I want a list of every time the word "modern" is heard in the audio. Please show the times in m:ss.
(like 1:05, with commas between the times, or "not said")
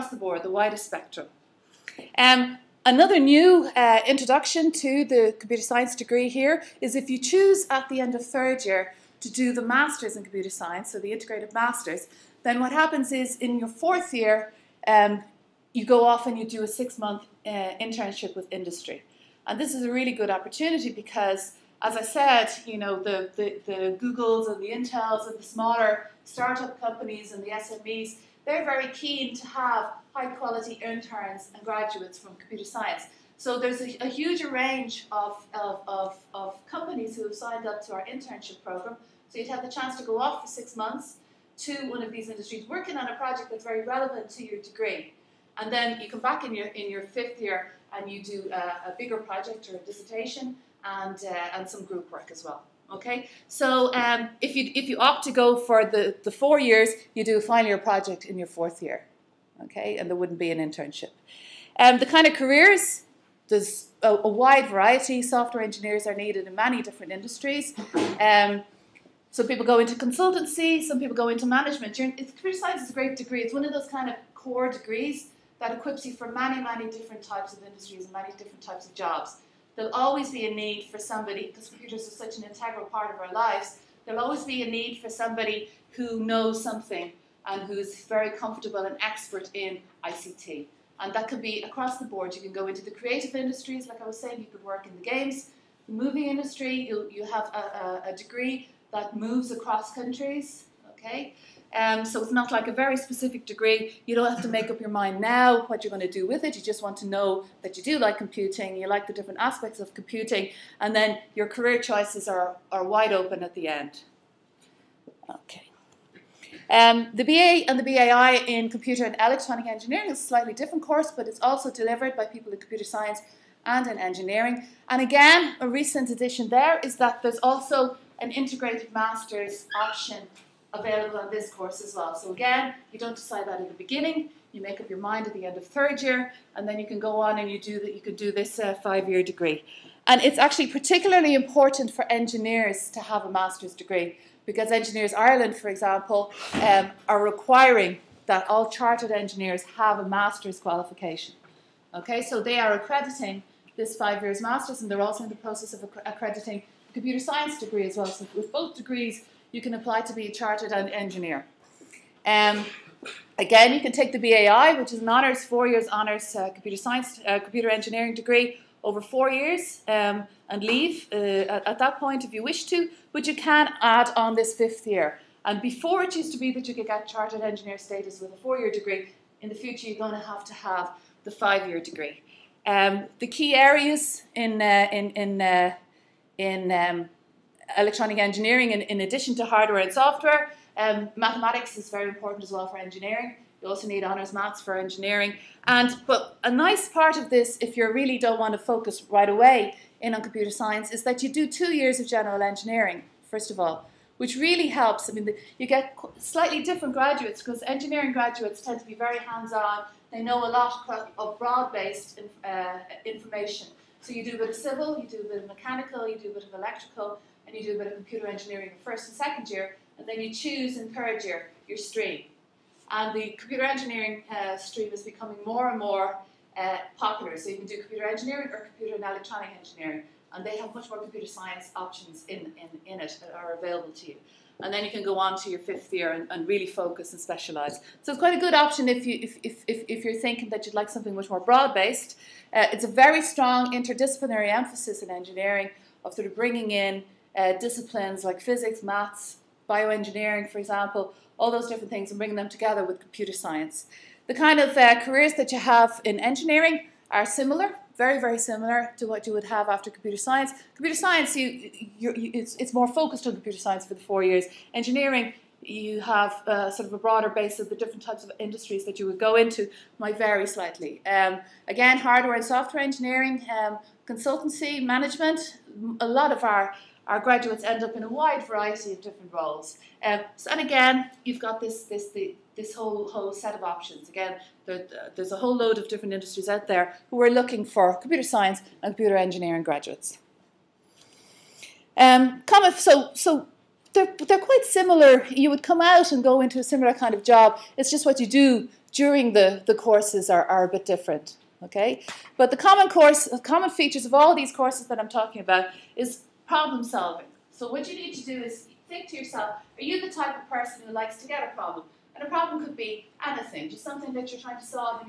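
not said.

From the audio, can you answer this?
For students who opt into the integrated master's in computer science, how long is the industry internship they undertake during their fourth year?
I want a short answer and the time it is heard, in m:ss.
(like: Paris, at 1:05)
6 months, at 0:16.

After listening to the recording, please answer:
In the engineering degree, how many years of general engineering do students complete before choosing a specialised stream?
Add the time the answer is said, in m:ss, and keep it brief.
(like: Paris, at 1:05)
2, at 3:21.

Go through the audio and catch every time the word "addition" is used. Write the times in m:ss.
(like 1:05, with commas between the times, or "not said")
2:06, 3:08.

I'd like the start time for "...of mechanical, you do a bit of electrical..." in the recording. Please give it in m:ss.
3:35.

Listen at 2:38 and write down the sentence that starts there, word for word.
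So with both degrees, you can apply to be a chartered engineer.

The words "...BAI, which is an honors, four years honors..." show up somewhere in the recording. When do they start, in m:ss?
2:44.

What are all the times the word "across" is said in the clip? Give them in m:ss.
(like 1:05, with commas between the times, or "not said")
1:31, 1:39.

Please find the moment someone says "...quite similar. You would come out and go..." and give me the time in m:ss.
4:54.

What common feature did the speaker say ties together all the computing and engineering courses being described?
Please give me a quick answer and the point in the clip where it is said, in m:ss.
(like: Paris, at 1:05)
Problem solving, at 5:06.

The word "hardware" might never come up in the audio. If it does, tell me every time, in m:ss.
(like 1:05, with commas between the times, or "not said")
3:09, 4:31.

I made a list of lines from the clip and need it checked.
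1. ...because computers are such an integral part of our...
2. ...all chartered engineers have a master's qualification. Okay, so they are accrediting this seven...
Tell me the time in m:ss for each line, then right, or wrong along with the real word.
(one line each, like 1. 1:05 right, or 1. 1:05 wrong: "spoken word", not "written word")
1. 1:21 right
2. 2:28 wrong: "five", not "seven".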